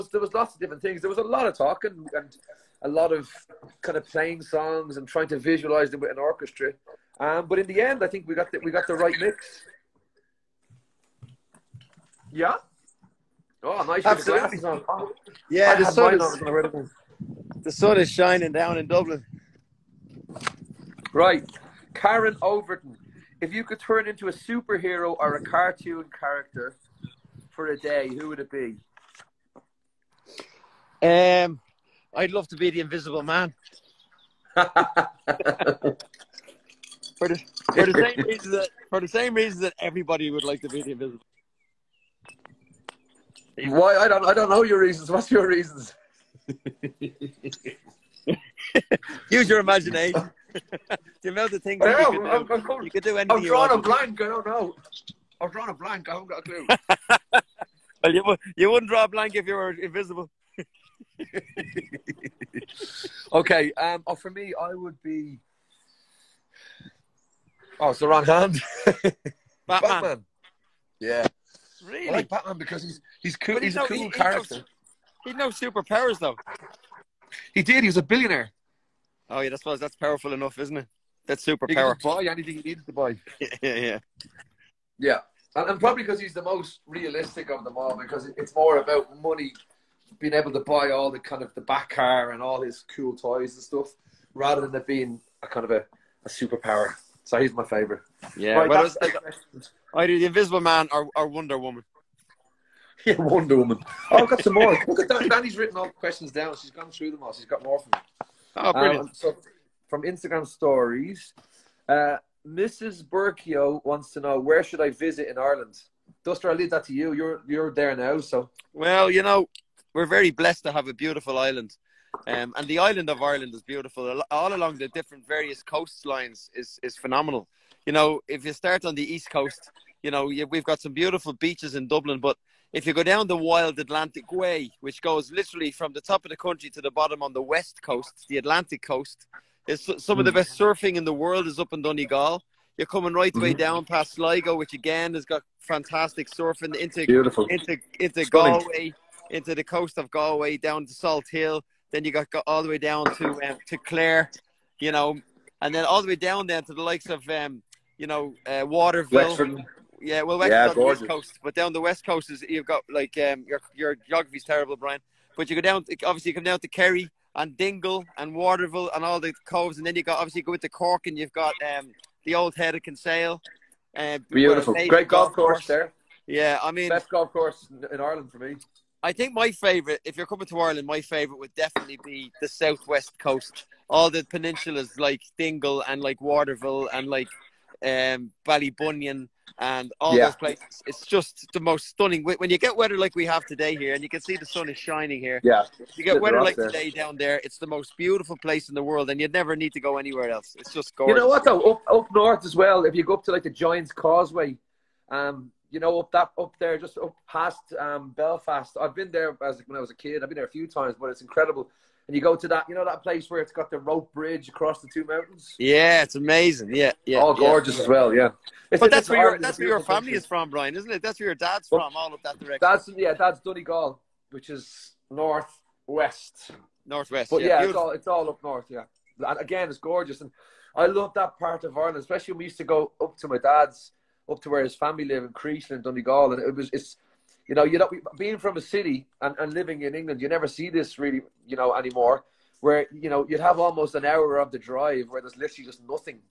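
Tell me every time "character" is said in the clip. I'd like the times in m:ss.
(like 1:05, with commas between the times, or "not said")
0:26, 1:14.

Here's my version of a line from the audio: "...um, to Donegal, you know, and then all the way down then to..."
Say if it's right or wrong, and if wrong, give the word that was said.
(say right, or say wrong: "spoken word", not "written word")
wrong: "Clare", not "Donegal".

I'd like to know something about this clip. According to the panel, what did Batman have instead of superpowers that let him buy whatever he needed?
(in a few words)
He was a billionaire.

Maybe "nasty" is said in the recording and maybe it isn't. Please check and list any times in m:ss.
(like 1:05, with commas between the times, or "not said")
not said.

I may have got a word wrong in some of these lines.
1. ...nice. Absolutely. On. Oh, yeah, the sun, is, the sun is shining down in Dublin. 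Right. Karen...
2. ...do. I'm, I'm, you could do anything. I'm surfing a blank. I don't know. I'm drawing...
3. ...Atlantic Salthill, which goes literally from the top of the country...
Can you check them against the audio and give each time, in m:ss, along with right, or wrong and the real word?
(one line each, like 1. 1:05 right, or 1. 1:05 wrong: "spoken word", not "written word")
1. 0:13 right
2. 0:52 wrong: "drawing", not "surfing"
3. 2:13 wrong: "Way", not "Salthill".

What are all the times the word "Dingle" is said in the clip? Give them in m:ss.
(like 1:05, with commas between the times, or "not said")
2:47, 3:05.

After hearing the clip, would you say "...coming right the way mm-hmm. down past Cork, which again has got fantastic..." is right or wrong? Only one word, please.
wrong.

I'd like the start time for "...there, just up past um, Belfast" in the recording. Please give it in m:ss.
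3:26.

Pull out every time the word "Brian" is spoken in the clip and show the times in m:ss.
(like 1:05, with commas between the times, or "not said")
2:44, 3:40.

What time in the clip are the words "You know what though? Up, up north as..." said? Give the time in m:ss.
3:21.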